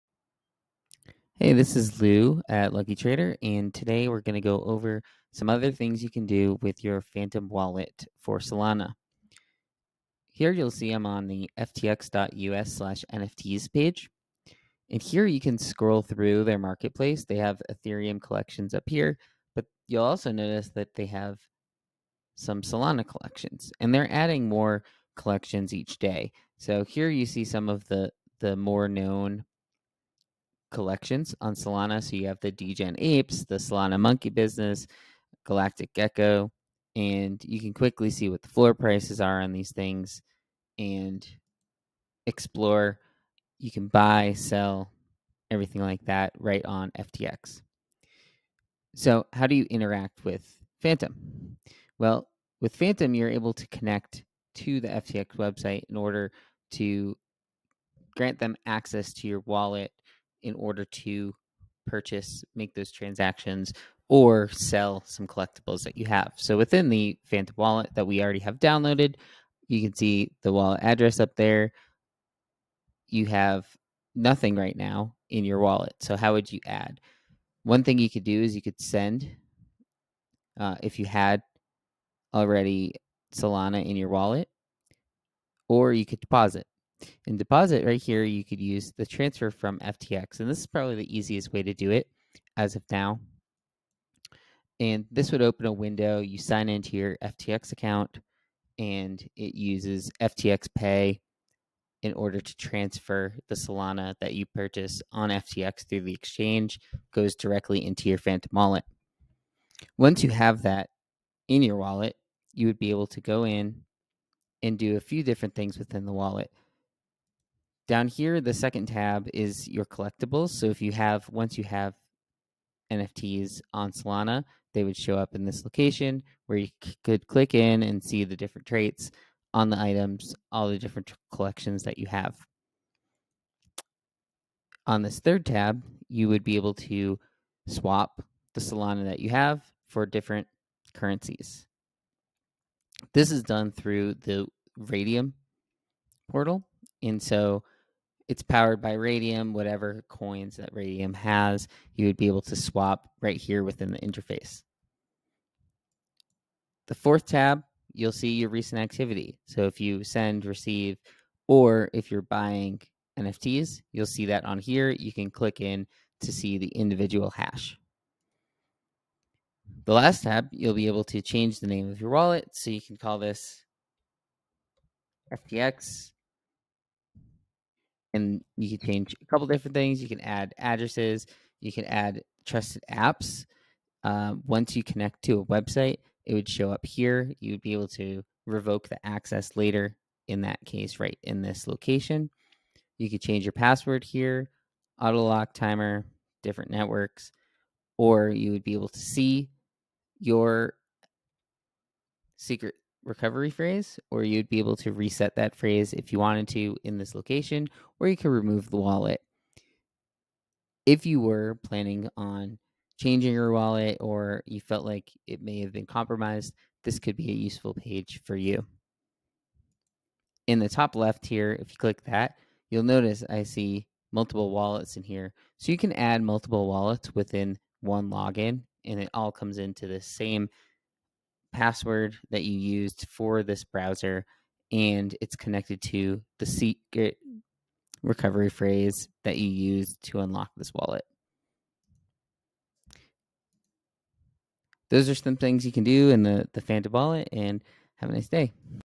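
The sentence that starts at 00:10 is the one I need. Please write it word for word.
Here you'll see I'm on the ftx.us slash NFTs page.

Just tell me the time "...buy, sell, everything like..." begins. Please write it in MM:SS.
00:43.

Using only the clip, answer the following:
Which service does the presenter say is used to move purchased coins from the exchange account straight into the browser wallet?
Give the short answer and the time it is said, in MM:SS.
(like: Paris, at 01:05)
FTX Pay, at 01:40.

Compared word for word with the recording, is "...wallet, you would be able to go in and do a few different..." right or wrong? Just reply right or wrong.
right.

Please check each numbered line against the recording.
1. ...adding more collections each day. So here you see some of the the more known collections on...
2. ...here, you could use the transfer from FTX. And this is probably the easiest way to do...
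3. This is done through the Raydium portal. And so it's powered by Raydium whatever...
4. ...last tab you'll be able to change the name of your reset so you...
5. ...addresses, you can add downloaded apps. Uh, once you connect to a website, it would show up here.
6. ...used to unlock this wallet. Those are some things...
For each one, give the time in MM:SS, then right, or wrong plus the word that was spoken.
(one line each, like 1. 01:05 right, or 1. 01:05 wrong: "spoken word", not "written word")
1. 00:24 right
2. 01:28 right
3. 02:23 right
4. 02:49 wrong: "wallet", not "reset"
5. 03:00 wrong: "trusted", not "downloaded"
6. 03:59 right.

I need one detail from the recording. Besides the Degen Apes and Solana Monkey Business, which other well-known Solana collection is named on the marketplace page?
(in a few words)
Galactic Gecko.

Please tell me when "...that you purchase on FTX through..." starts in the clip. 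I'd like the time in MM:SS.
01:44.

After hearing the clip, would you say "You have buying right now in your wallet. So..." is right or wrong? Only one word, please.
wrong.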